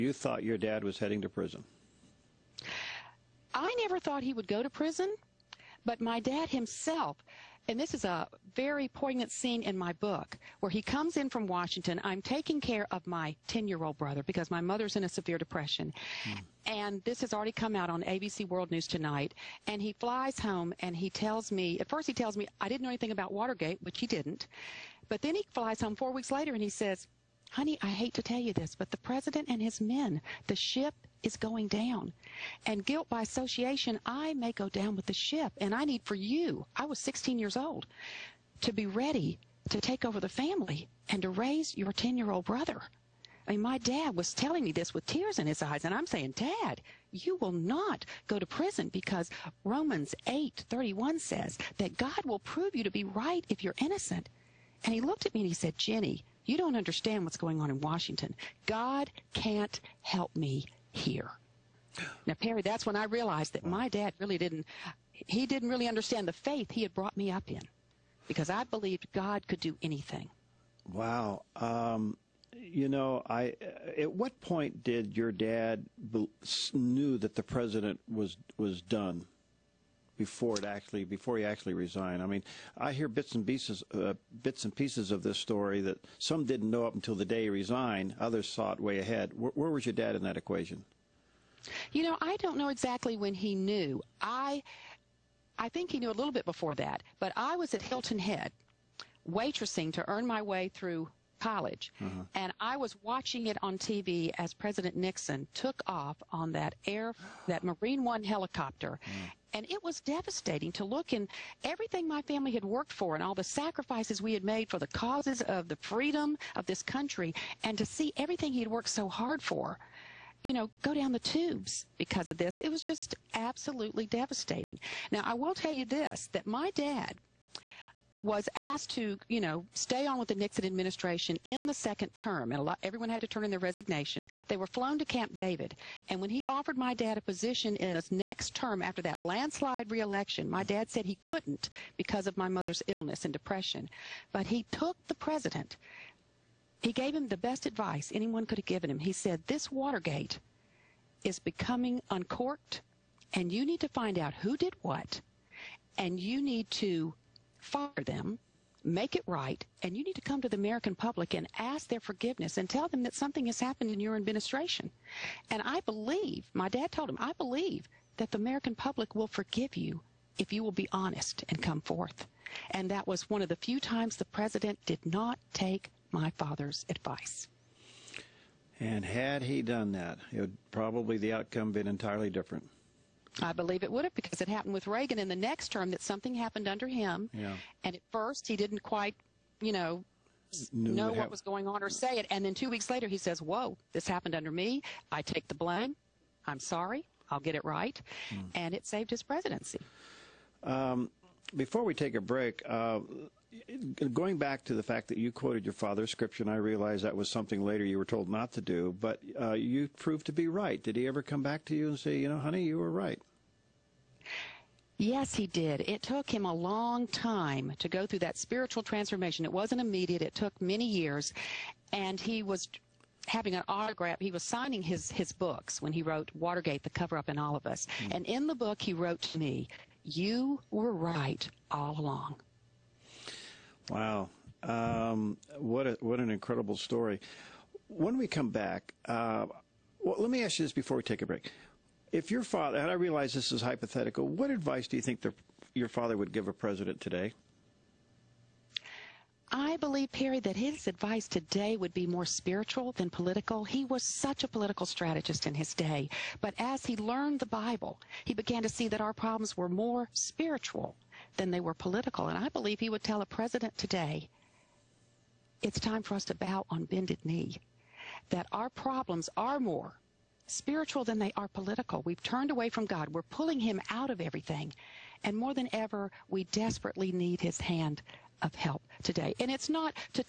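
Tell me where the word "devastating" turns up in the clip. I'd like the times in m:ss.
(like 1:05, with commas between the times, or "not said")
1:50, 2:04.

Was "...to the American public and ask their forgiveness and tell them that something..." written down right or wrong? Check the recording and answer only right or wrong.
right.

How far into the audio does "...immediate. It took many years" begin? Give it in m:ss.
3:39.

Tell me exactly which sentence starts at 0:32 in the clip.
And guilt by association, I may go down with the ship.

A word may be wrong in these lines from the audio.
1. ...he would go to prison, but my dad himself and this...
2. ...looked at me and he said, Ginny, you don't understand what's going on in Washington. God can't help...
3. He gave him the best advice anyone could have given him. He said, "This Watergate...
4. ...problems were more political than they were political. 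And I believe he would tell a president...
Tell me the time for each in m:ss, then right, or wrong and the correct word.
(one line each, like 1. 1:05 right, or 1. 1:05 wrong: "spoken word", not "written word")
1. 0:04 right
2. 0:55 right
3. 2:26 right
4. 4:19 wrong: "spiritual", not "political".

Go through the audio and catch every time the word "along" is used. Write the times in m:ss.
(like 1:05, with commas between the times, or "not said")
3:51.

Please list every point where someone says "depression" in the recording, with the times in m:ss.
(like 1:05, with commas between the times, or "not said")
0:15, 2:23.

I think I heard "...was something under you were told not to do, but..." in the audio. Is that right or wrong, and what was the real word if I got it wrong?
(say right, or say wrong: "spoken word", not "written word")
wrong: "later", not "under".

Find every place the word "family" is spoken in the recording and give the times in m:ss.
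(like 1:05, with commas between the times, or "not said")
0:40, 1:52.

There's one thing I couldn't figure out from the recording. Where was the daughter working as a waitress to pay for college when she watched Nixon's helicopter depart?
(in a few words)
Hilton Head.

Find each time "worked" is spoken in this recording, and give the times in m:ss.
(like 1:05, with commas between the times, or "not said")
1:52, 1:58.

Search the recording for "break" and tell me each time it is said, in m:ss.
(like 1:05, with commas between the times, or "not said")
3:22, 4:01.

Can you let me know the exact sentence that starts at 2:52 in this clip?
And that was one of the few times the president did not take my father's advice.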